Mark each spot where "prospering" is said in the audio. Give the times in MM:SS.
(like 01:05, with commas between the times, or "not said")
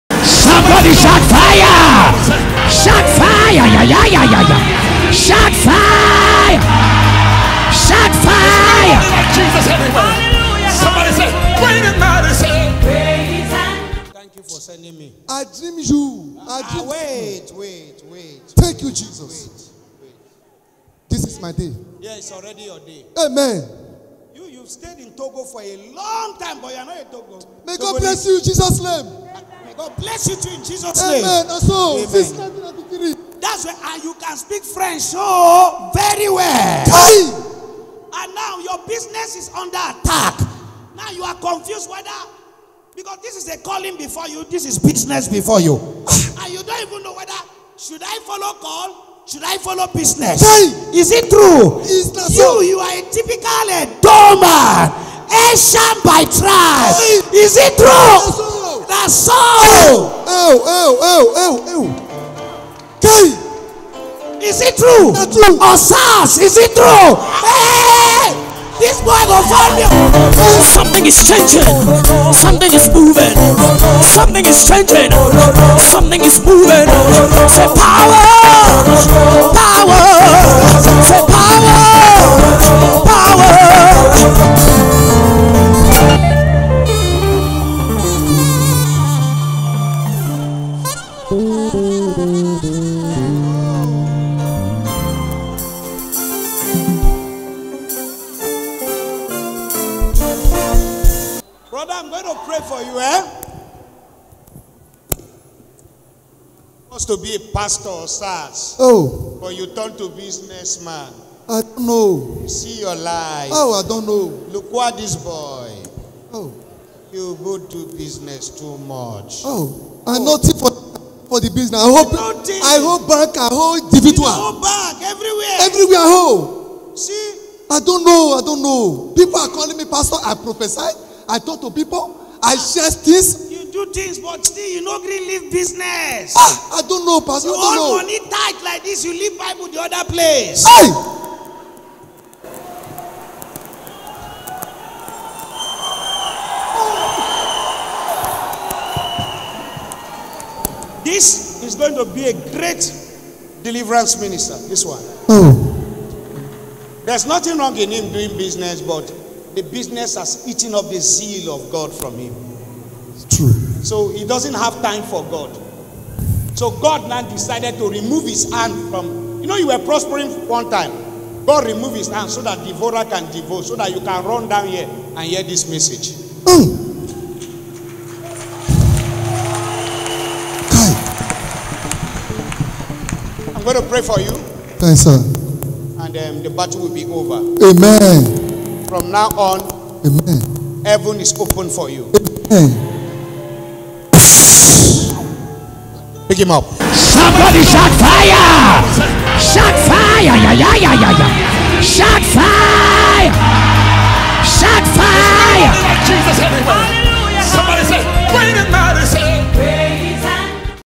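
02:49.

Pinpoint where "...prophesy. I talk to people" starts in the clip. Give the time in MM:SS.
02:10.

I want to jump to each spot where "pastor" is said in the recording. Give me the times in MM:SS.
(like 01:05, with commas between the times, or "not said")
01:47, 02:09, 02:17.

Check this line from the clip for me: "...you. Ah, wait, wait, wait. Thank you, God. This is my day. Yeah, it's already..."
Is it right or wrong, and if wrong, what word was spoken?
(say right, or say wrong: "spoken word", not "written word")
wrong: "Jesus", not "God".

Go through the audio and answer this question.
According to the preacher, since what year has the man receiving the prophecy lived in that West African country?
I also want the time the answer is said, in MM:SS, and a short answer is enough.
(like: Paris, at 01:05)
1993, at 00:32.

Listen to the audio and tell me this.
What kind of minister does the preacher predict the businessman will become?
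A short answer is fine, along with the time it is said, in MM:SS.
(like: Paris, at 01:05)
Deliverance minister, at 02:33.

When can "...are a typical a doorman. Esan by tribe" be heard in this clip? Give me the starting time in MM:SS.
00:52.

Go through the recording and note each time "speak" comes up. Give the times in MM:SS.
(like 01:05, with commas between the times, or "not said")
00:34.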